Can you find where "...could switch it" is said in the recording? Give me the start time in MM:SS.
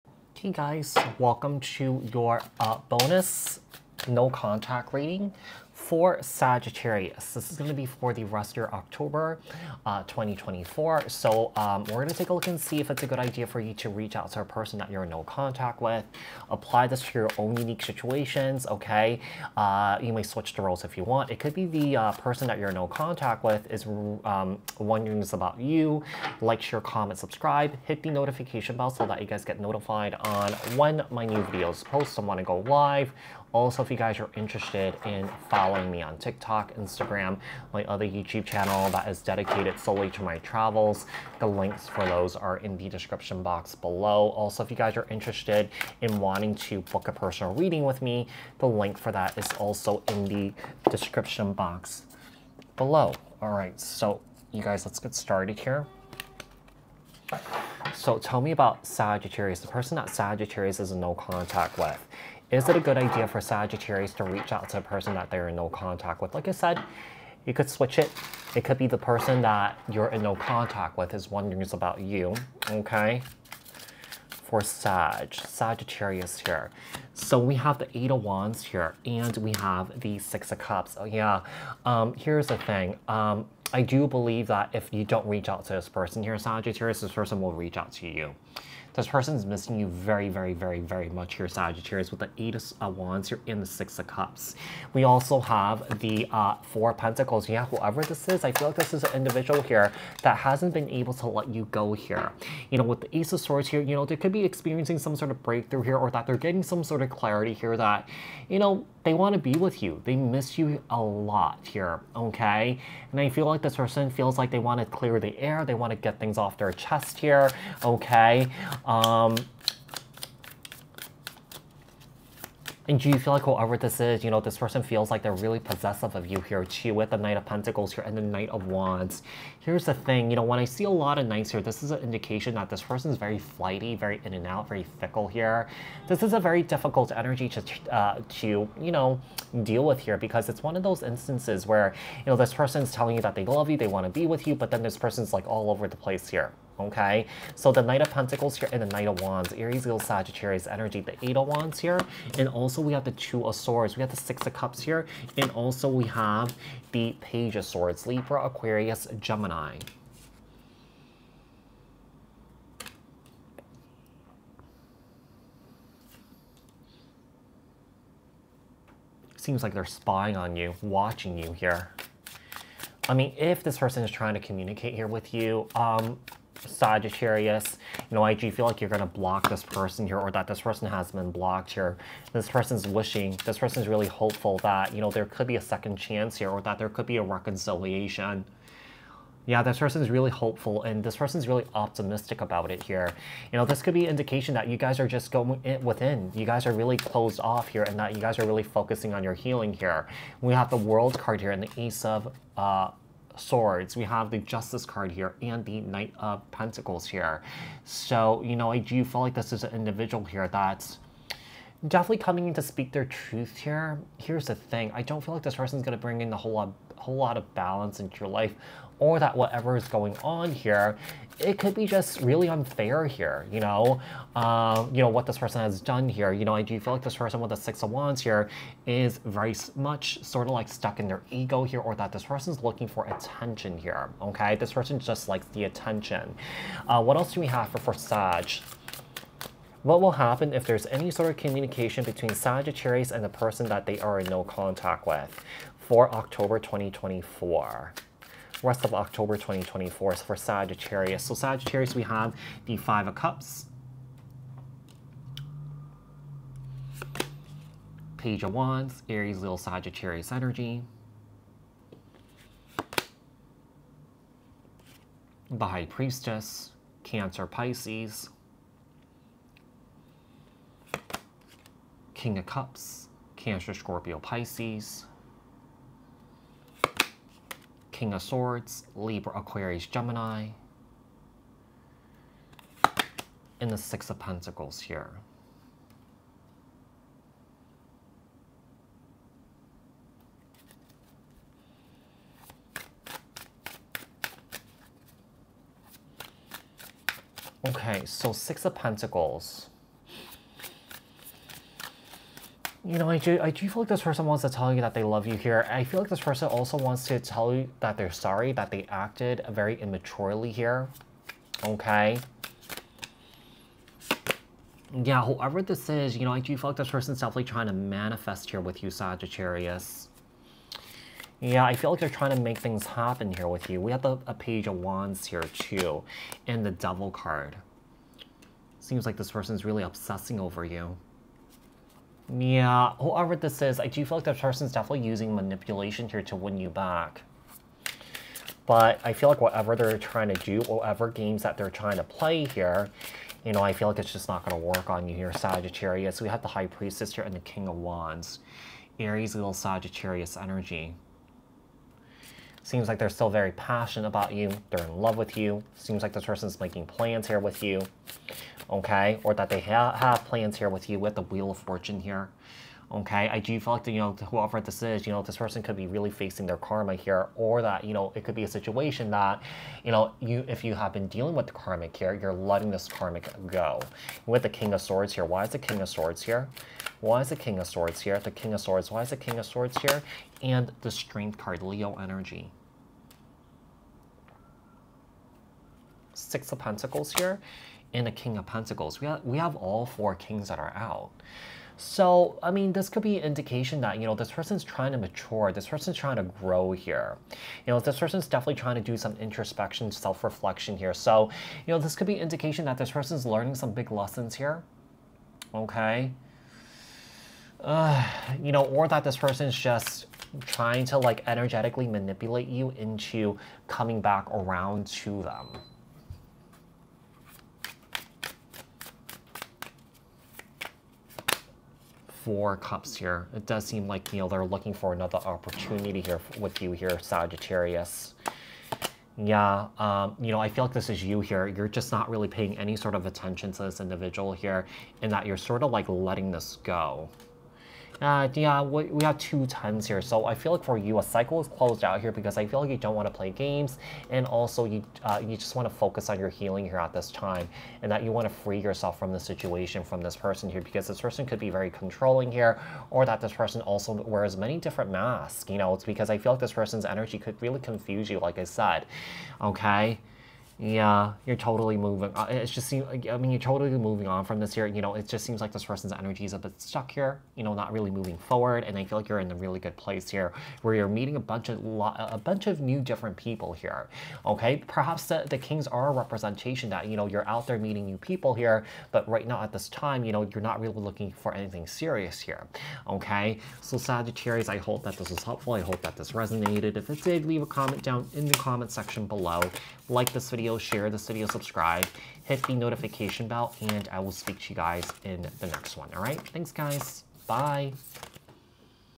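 01:07.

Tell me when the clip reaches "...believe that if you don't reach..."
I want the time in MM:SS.
01:24.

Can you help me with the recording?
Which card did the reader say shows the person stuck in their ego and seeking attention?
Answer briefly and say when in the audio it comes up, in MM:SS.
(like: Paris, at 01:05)
Six of Wands, at 03:47.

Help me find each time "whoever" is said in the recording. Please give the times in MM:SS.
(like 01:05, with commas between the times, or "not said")
01:37, 02:03, 05:15, 05:32, 06:04.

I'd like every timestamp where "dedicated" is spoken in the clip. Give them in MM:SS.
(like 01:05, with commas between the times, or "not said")
00:39.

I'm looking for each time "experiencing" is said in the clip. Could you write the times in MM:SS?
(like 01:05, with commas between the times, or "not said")
01:44.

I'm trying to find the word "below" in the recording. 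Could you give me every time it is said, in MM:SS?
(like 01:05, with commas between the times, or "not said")
00:43, 00:52, 08:09.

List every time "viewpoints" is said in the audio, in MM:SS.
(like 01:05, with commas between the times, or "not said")
not said.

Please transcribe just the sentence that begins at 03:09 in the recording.
Yeah, this person's really hopeful and this person's really optimistic about it here.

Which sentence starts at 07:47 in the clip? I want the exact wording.
You know, not really moving forward.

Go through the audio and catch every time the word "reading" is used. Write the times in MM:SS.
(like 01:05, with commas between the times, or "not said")
00:04, 00:47.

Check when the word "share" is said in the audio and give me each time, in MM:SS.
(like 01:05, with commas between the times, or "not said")
00:26, 08:10.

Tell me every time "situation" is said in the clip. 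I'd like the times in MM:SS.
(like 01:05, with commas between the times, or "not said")
00:17, 06:08, 07:29.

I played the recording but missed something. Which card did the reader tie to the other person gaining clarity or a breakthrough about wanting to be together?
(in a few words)
Ace of Swords.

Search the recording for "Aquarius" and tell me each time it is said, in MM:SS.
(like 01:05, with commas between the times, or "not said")
02:38, 04:39.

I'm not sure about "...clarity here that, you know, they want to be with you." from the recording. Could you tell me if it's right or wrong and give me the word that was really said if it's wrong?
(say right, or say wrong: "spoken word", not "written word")
right.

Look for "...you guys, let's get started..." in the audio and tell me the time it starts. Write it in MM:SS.
00:54.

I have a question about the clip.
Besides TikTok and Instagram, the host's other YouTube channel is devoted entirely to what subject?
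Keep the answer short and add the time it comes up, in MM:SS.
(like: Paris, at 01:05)
Travels, at 00:40.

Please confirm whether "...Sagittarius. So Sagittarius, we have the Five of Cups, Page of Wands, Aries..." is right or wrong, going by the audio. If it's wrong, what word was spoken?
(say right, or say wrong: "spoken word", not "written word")
right.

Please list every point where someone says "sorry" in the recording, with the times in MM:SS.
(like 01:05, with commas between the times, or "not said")
05:08.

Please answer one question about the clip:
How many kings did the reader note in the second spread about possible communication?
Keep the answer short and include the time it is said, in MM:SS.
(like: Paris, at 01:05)
4, at 06:29.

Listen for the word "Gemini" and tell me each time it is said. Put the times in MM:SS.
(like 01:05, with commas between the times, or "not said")
02:39, 04:39.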